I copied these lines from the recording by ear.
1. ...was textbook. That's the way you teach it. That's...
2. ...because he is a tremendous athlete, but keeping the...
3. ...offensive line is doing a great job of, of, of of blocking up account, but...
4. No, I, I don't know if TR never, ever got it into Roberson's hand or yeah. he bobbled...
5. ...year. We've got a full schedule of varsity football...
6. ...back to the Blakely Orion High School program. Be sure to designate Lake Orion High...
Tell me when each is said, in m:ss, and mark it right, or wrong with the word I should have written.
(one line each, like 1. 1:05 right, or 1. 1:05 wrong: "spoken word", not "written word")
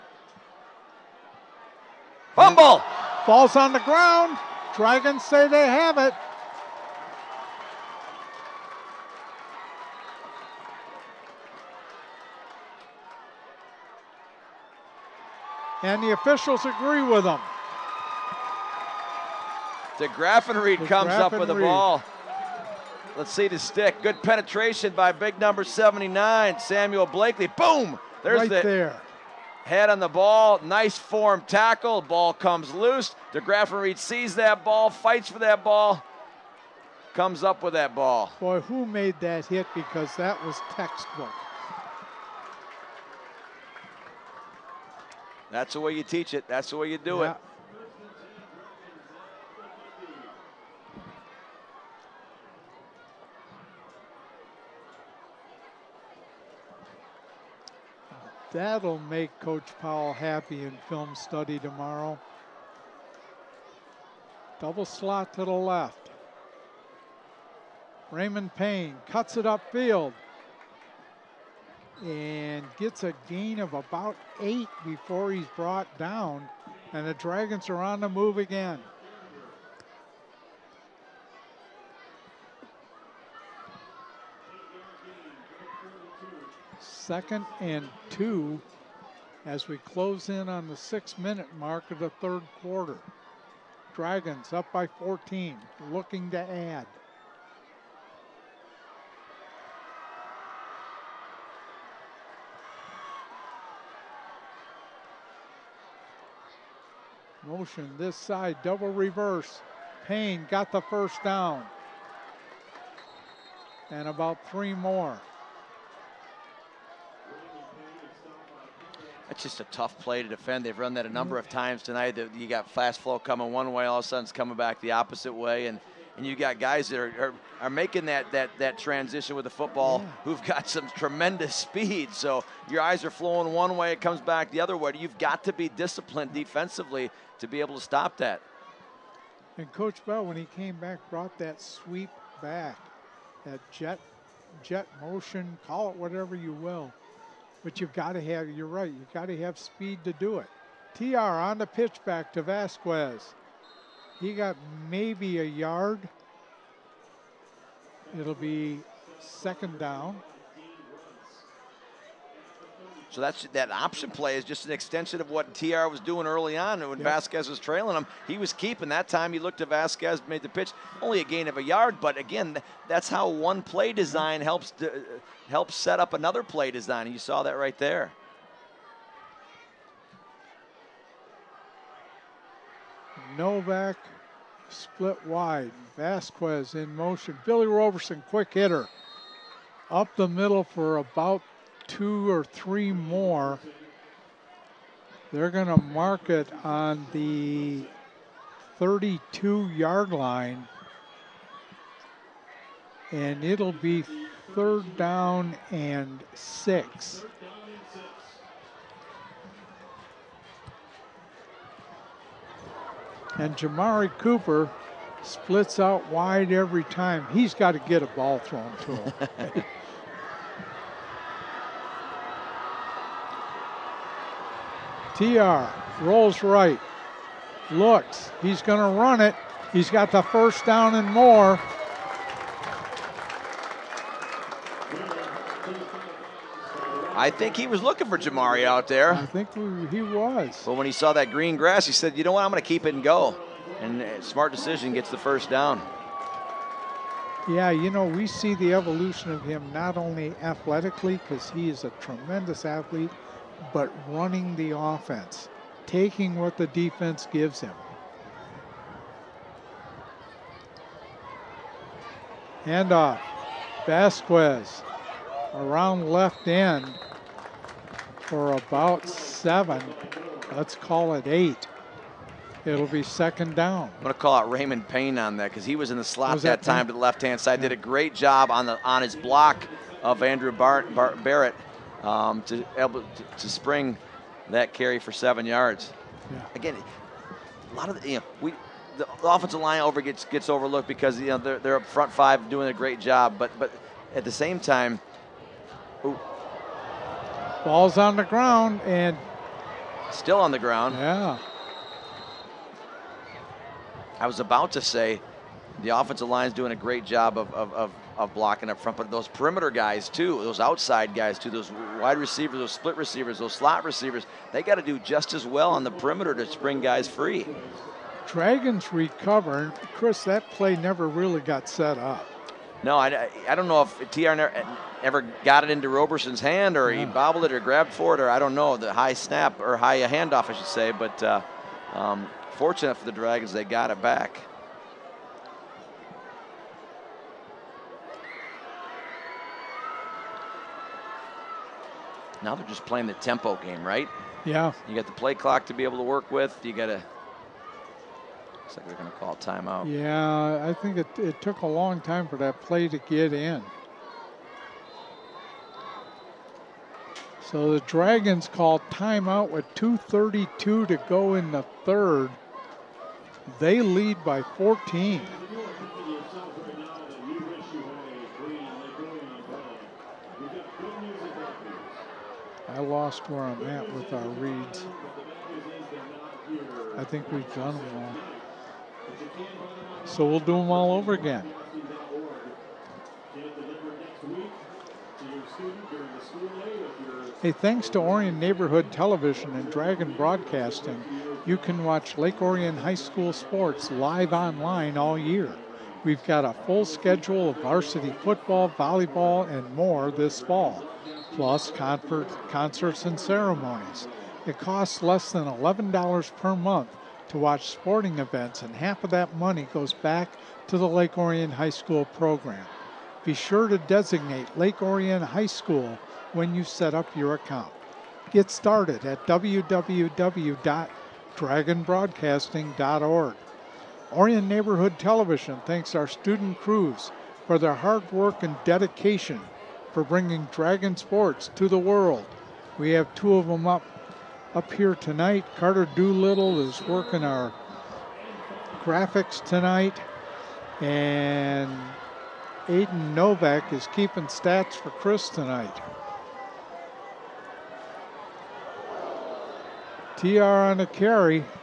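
1. 0:40 right
2. 4:11 wrong: "running", not "keeping"
3. 5:05 wrong: "front", not "account"
4. 5:22 right
5. 6:35 right
6. 6:49 wrong: "Lake", not "Blakely".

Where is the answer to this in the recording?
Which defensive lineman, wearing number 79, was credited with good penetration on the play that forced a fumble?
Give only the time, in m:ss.
0:26.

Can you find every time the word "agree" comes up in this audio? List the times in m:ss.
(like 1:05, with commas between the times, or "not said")
0:16.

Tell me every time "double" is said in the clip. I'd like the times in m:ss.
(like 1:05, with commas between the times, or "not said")
1:04, 1:48.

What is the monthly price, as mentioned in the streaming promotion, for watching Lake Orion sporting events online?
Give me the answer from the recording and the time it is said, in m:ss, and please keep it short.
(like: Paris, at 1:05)
less than $11, at 6:45.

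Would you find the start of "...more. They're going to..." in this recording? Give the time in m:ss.
3:12.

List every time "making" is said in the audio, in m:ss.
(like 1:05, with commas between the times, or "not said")
2:07.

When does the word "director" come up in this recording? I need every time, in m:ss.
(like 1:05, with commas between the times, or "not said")
not said.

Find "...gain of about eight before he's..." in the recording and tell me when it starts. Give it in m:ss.
1:13.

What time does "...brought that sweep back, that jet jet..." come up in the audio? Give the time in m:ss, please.
2:21.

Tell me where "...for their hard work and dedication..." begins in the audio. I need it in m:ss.
7:07.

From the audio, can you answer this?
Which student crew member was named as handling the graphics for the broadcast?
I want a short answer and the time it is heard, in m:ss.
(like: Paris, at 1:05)
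Carter Doolittle, at 7:15.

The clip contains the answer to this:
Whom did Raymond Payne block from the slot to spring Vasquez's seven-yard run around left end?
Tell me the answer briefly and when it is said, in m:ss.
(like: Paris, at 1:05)
Andrew Barrett, at 4:40.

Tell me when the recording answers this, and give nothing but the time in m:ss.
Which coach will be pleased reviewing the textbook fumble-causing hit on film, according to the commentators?
0:59.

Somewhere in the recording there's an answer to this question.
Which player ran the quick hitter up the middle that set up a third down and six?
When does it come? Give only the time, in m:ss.
3:07.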